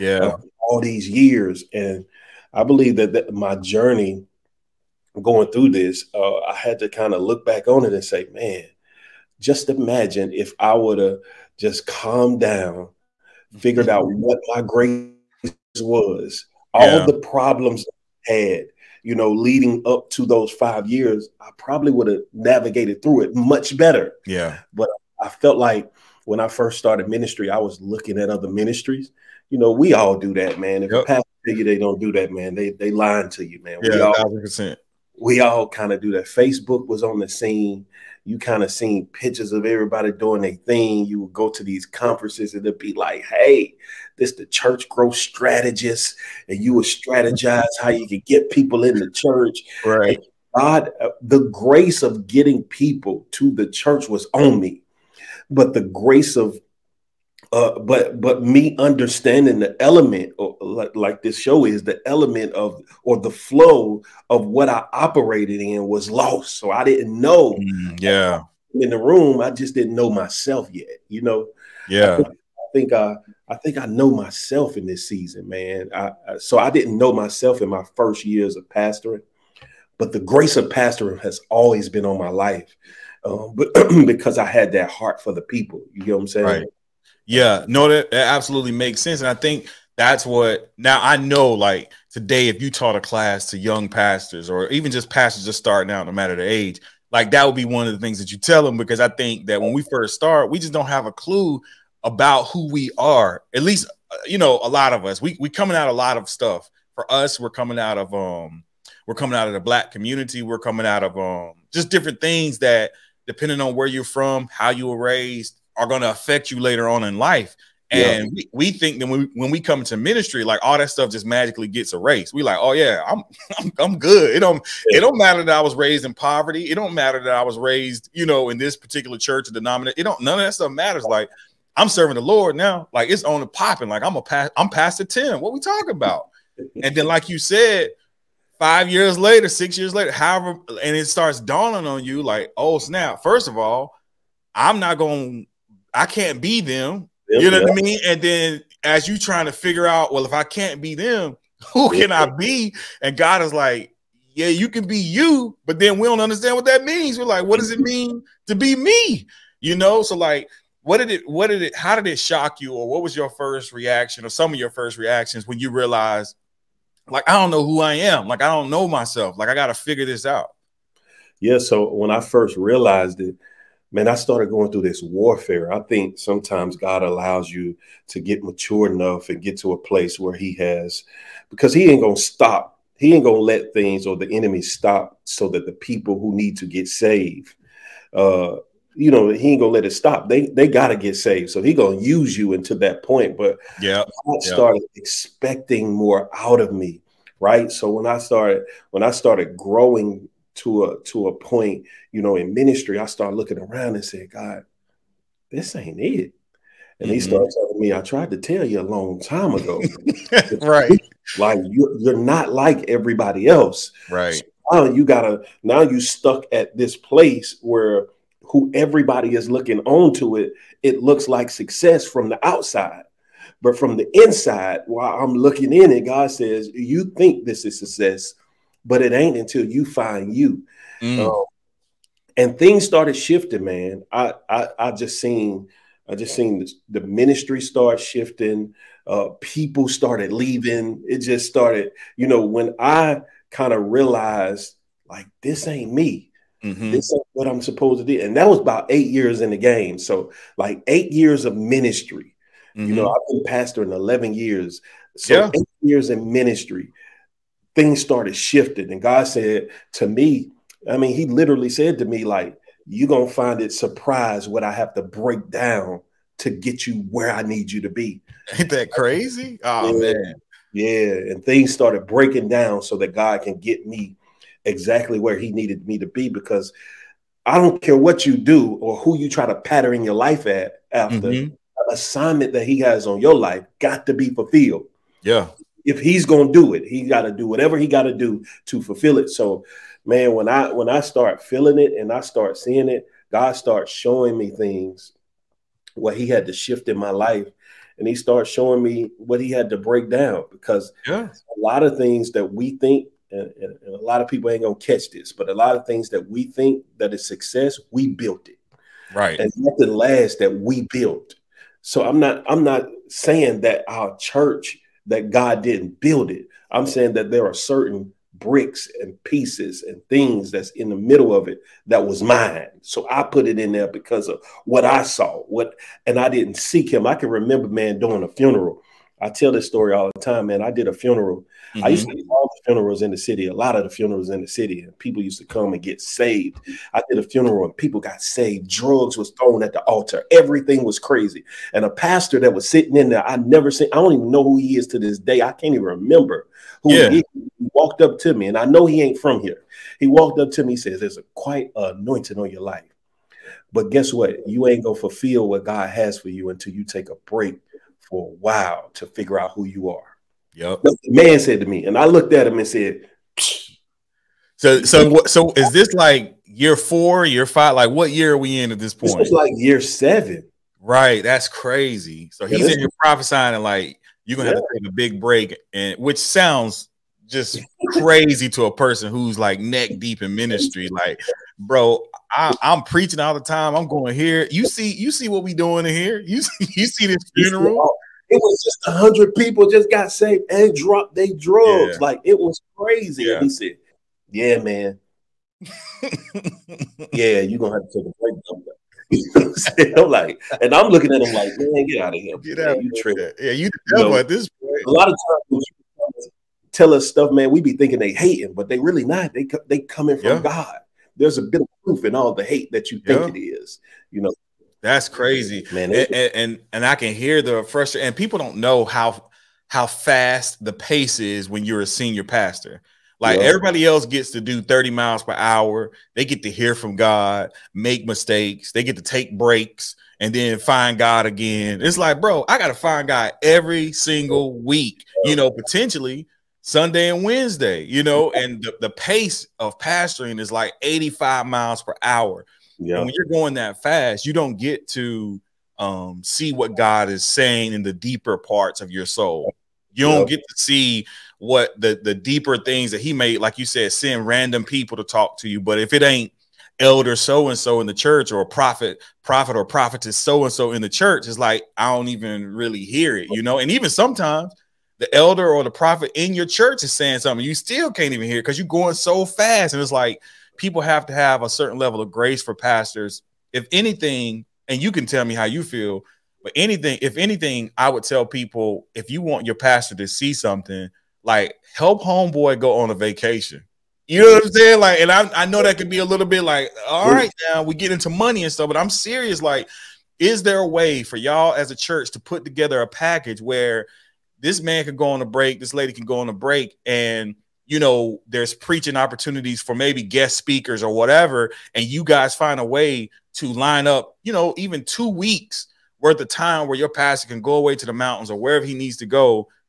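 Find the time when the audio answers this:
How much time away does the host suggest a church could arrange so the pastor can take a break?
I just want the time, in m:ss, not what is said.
8:24.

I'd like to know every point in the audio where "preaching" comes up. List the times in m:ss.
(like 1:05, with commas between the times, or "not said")
6:22, 8:18.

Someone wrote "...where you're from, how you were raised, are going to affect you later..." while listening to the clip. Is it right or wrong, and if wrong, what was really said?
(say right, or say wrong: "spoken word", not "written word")
right.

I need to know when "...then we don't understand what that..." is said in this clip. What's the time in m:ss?
2:35.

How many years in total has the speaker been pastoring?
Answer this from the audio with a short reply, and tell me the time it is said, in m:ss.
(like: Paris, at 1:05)
11, at 4:13.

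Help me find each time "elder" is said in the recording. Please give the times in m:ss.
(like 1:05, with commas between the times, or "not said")
7:36, 7:45.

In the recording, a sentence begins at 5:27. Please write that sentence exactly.
I can remember man doing a funeral I tell this story all the time, man.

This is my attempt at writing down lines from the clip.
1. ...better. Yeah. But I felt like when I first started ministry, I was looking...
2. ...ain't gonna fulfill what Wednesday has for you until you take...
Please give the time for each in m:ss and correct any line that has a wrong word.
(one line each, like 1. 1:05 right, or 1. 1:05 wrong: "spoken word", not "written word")
1. 0:23 right
2. 5:54 wrong: "God", not "Wednesday".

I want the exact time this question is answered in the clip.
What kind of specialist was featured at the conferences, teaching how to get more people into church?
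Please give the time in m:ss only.
0:44.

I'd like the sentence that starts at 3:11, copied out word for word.
So he gonna use you until that point.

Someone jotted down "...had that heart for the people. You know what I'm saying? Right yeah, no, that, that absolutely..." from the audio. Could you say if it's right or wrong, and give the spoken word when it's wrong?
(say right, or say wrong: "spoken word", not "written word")
right.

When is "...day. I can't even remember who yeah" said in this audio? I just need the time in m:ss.
5:45.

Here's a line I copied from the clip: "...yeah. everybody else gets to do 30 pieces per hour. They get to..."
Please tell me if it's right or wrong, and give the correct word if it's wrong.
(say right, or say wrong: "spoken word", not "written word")
wrong: "miles", not "pieces".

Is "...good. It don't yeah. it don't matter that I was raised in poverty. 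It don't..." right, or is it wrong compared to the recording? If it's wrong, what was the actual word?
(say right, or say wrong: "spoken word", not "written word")
right.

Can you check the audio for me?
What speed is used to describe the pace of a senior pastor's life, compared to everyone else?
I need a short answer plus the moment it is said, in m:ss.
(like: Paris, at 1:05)
85 miles per hour, at 7:20.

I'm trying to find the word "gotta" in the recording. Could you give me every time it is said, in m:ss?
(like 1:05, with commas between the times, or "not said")
3:10, 3:35.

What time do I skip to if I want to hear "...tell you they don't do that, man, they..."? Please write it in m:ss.
0:31.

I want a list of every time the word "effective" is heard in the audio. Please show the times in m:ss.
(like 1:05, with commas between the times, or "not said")
not said.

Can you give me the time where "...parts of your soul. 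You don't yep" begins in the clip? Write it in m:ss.
7:28.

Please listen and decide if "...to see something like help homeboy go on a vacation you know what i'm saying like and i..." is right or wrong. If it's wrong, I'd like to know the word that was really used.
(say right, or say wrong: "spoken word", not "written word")
right.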